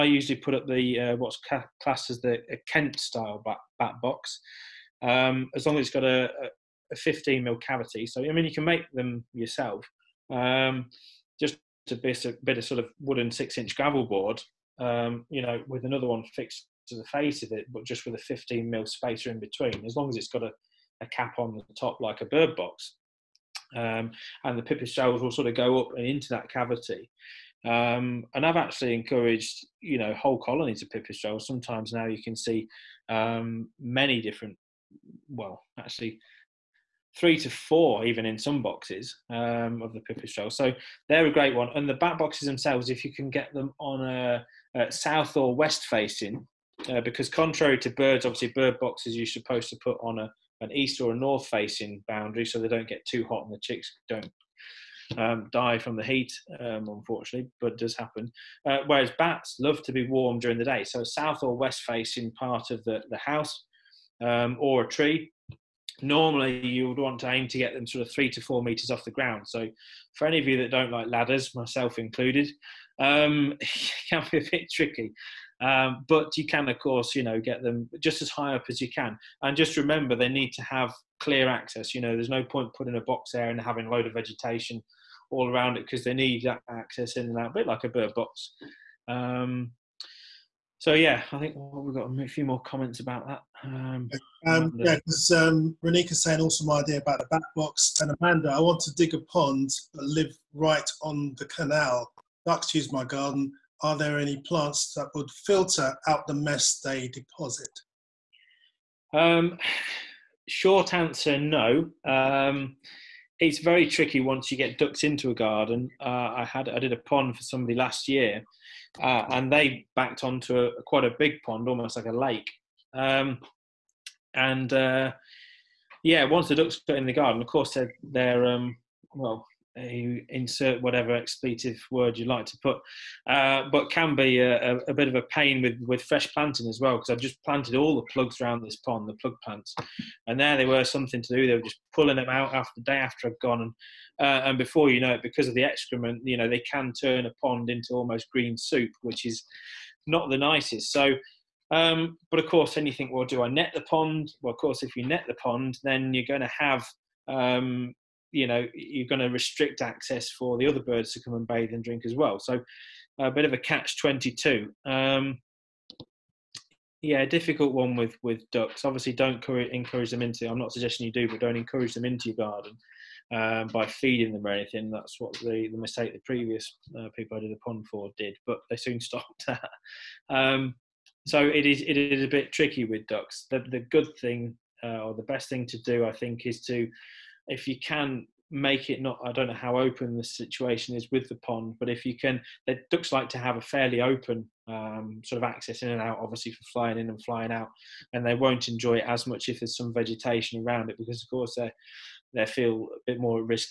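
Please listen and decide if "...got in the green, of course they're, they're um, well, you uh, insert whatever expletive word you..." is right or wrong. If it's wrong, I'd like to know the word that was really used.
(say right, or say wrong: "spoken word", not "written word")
wrong: "garden", not "green".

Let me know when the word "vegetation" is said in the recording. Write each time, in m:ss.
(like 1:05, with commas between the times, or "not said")
1:24, 3:19.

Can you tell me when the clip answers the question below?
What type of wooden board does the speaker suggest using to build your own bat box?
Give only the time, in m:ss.
0:13.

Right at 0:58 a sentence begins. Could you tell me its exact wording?
Uh, whereas bats love to be warm during the day.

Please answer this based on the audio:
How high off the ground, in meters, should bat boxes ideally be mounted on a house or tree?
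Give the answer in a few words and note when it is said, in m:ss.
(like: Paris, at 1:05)
3 to 4 meters, at 1:08.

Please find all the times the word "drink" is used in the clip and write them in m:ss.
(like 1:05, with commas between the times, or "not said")
2:41.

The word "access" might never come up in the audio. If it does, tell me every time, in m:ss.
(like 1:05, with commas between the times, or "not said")
1:21, 1:26, 2:39, 3:15.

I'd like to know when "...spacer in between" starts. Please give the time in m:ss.
0:18.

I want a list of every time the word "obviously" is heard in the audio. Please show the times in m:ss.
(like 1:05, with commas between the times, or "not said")
0:48, 2:48, 3:16.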